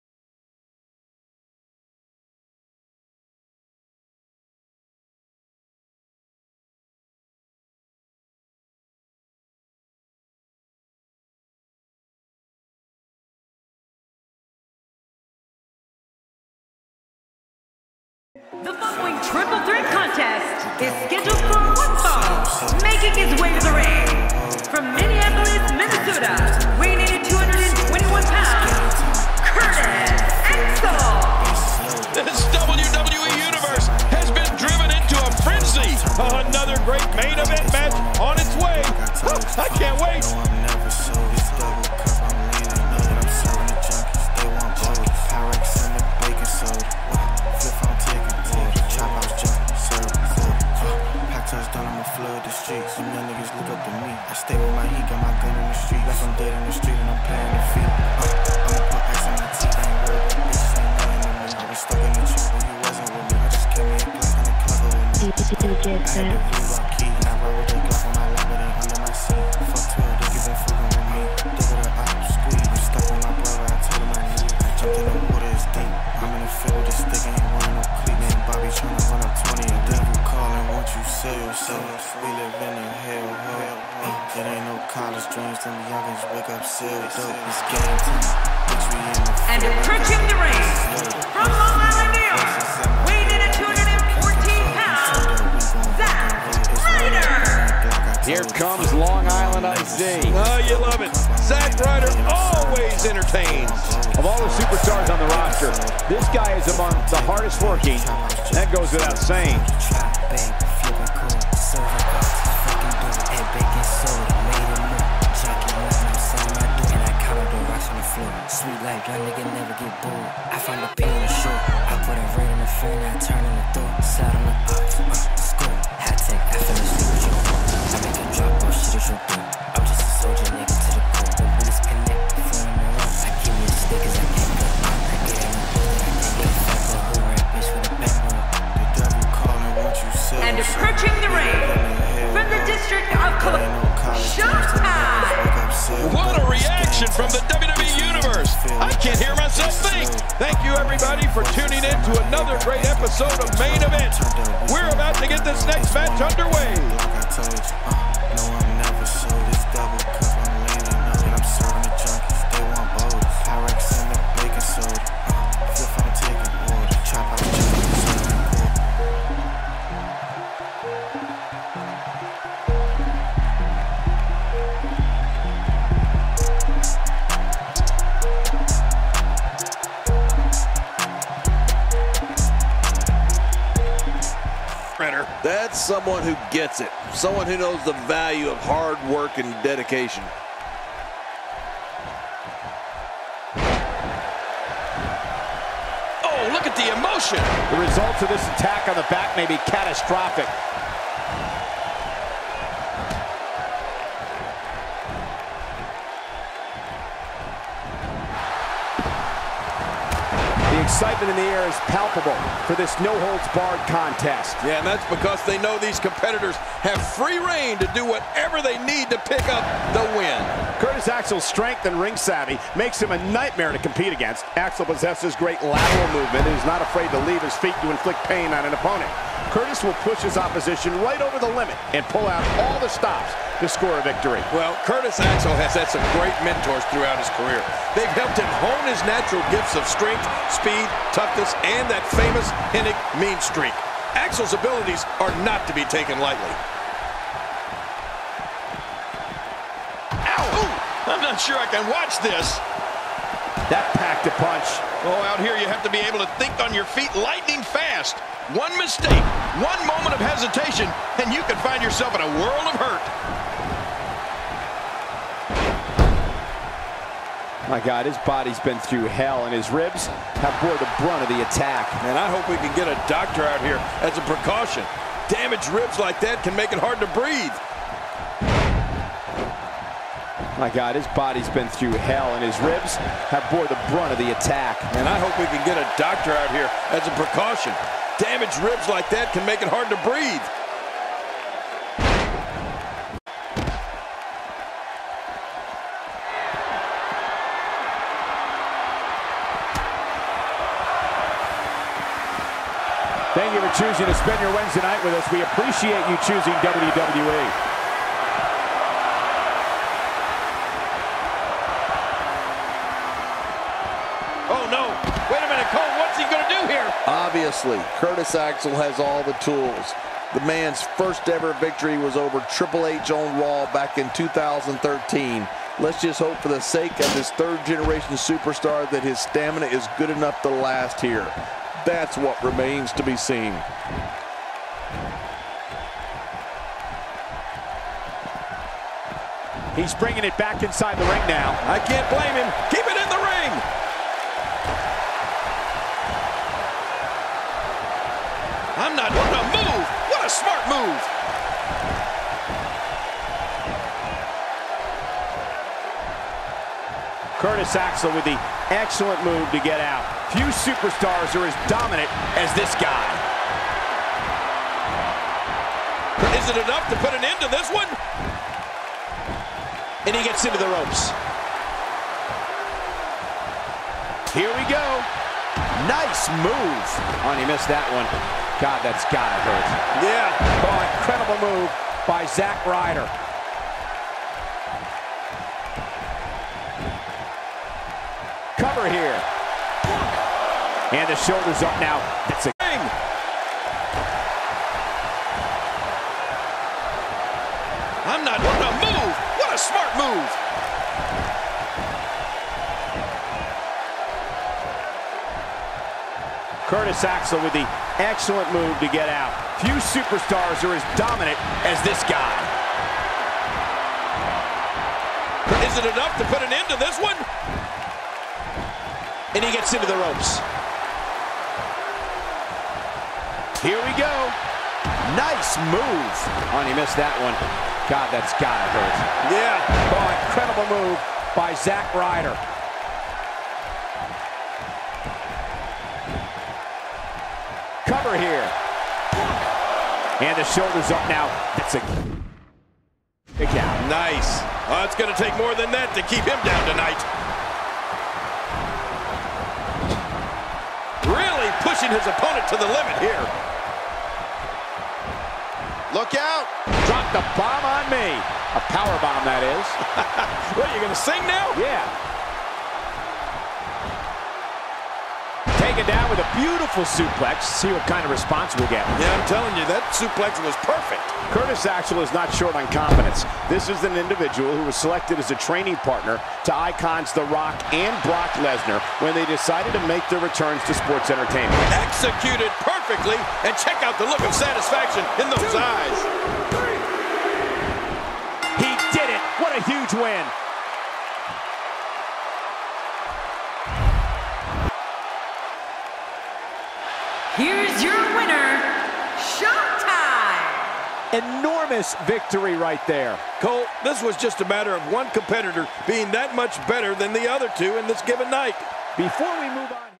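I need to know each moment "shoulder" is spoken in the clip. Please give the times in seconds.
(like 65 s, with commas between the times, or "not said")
391 s, 440 s.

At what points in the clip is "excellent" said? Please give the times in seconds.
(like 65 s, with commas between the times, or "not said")
358 s, 408 s.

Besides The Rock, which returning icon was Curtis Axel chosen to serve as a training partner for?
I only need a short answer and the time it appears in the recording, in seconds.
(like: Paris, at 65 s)
Brock Lesnar, at 478 s.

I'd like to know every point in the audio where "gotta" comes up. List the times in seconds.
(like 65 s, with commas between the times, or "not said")
379 s, 428 s.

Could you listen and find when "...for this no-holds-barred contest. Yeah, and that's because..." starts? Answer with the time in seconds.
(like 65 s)
212 s.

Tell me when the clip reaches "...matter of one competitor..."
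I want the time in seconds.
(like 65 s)
504 s.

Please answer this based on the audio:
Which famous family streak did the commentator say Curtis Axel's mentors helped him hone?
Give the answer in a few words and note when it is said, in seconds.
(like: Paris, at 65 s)
Hennig mean streak, at 242 s.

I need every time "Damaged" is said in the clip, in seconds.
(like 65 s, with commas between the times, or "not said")
275 s, 288 s.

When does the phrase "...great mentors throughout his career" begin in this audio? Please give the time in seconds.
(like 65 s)
236 s.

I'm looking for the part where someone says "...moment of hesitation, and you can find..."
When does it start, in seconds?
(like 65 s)
259 s.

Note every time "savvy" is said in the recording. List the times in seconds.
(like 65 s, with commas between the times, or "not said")
222 s.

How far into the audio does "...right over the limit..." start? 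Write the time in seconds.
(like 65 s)
231 s.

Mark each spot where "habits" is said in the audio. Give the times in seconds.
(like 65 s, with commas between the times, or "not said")
not said.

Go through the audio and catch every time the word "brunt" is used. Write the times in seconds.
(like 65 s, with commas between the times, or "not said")
270 s, 283 s.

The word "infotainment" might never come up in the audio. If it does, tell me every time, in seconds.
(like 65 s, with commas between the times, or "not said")
not said.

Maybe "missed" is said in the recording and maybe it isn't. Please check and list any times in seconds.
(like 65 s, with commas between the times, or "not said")
377 s, 426 s.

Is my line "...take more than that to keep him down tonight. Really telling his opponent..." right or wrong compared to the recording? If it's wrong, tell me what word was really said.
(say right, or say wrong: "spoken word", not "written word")
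wrong: "pushing", not "telling".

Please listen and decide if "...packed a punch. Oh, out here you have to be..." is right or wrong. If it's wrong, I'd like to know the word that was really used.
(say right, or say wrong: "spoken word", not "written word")
right.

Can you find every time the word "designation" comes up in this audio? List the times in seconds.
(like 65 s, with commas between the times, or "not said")
not said.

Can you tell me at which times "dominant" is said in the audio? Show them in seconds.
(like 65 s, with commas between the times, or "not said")
361 s, 410 s.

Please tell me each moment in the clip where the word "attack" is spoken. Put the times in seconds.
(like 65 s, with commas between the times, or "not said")
198 s, 271 s, 284 s.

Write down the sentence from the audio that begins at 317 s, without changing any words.
Obviously, Curtis Axel has all the tools.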